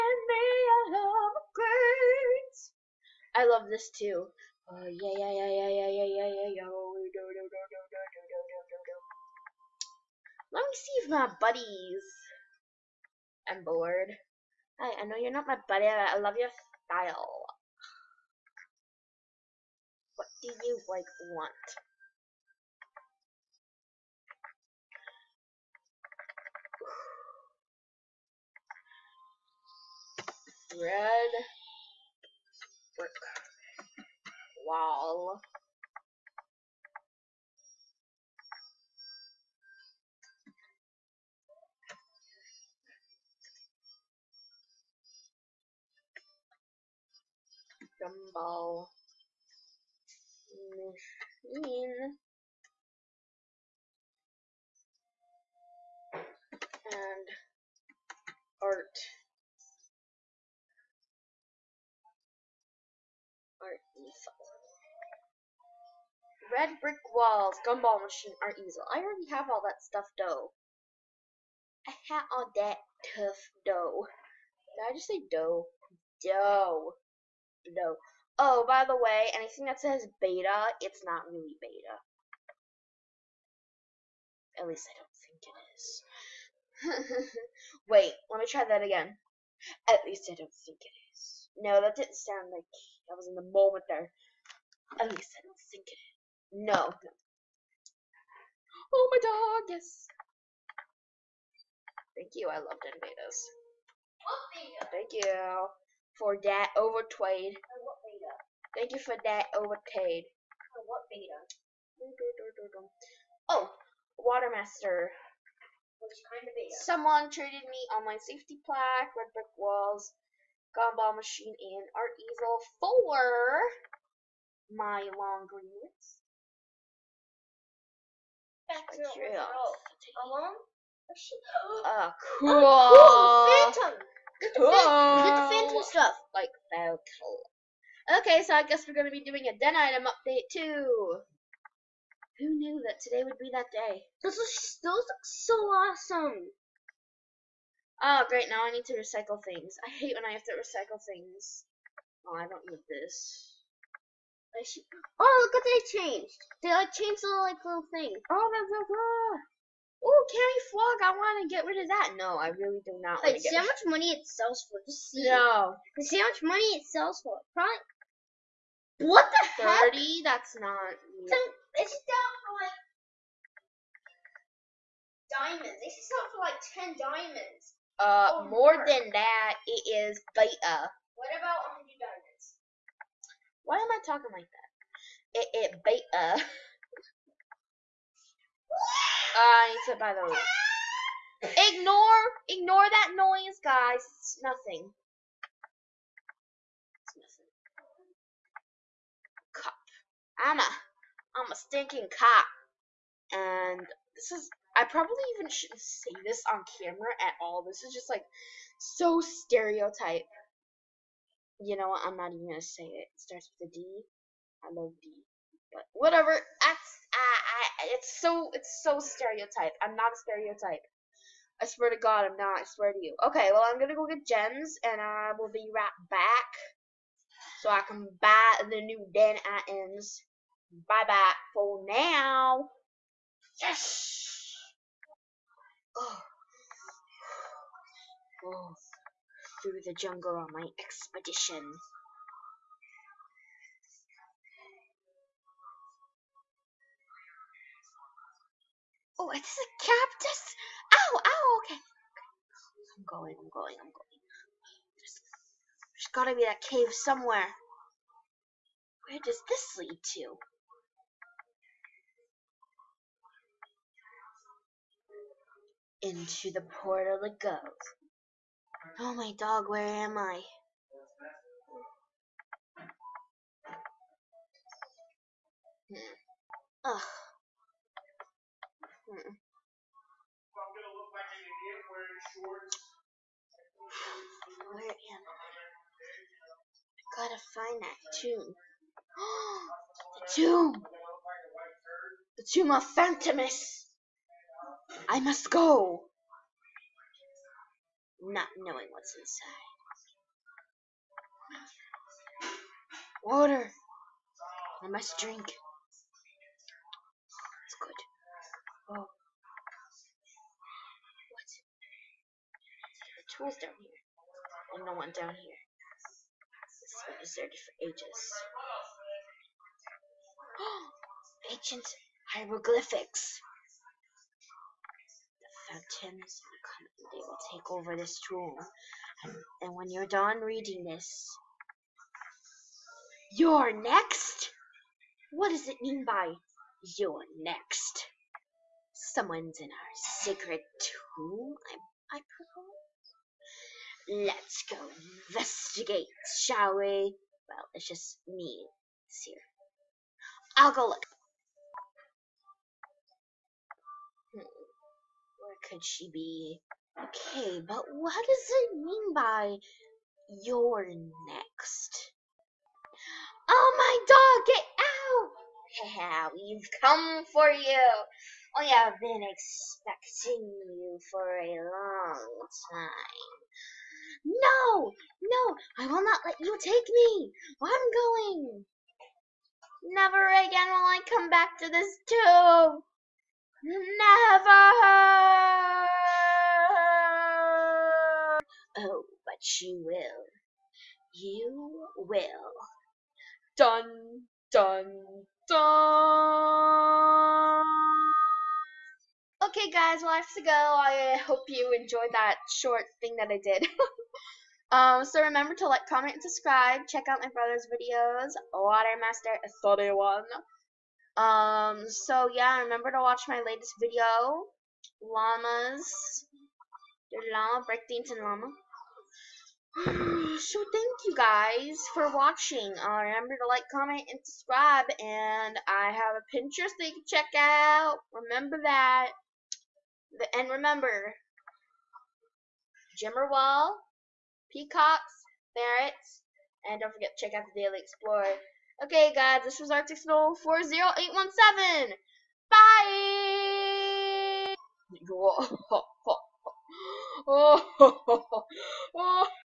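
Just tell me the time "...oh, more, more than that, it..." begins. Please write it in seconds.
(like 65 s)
178 s.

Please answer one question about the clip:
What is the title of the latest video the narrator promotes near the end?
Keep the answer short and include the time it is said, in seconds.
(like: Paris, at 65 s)
Llamas, your llama, and llama, at 415 s.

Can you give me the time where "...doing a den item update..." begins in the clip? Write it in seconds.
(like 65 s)
139 s.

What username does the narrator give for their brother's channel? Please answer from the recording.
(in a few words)
Watermaster 31.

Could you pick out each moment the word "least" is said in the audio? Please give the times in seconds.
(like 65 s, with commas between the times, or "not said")
84 s, 90 s, 95 s.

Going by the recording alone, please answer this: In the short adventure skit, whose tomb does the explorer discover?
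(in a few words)
Phantomus.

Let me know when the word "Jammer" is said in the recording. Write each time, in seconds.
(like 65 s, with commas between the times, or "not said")
432 s.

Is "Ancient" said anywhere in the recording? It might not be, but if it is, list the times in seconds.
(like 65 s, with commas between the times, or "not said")
321 s.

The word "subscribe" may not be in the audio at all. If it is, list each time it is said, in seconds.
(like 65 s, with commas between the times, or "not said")
406 s, 424 s.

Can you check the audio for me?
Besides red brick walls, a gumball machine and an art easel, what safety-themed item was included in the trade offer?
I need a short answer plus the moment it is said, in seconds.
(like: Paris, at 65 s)
online safety plaque, at 117 s.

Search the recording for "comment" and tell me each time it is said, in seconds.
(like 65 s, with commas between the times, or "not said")
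405 s, 423 s.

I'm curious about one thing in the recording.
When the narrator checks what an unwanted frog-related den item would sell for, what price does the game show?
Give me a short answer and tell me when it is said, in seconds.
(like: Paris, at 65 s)
30, at 169 s.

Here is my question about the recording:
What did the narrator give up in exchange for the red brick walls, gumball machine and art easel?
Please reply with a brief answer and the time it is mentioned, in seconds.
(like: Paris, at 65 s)
long greens, at 125 s.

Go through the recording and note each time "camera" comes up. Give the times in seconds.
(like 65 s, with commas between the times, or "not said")
206 s.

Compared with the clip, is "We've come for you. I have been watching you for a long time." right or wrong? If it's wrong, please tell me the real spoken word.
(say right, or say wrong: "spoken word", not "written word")
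wrong: "expecting", not "watching".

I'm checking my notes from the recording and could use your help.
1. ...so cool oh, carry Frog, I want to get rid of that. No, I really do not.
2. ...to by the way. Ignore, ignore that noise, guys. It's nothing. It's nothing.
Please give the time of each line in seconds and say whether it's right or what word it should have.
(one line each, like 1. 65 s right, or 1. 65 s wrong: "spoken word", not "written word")
1. 158 s right
2. 189 s right.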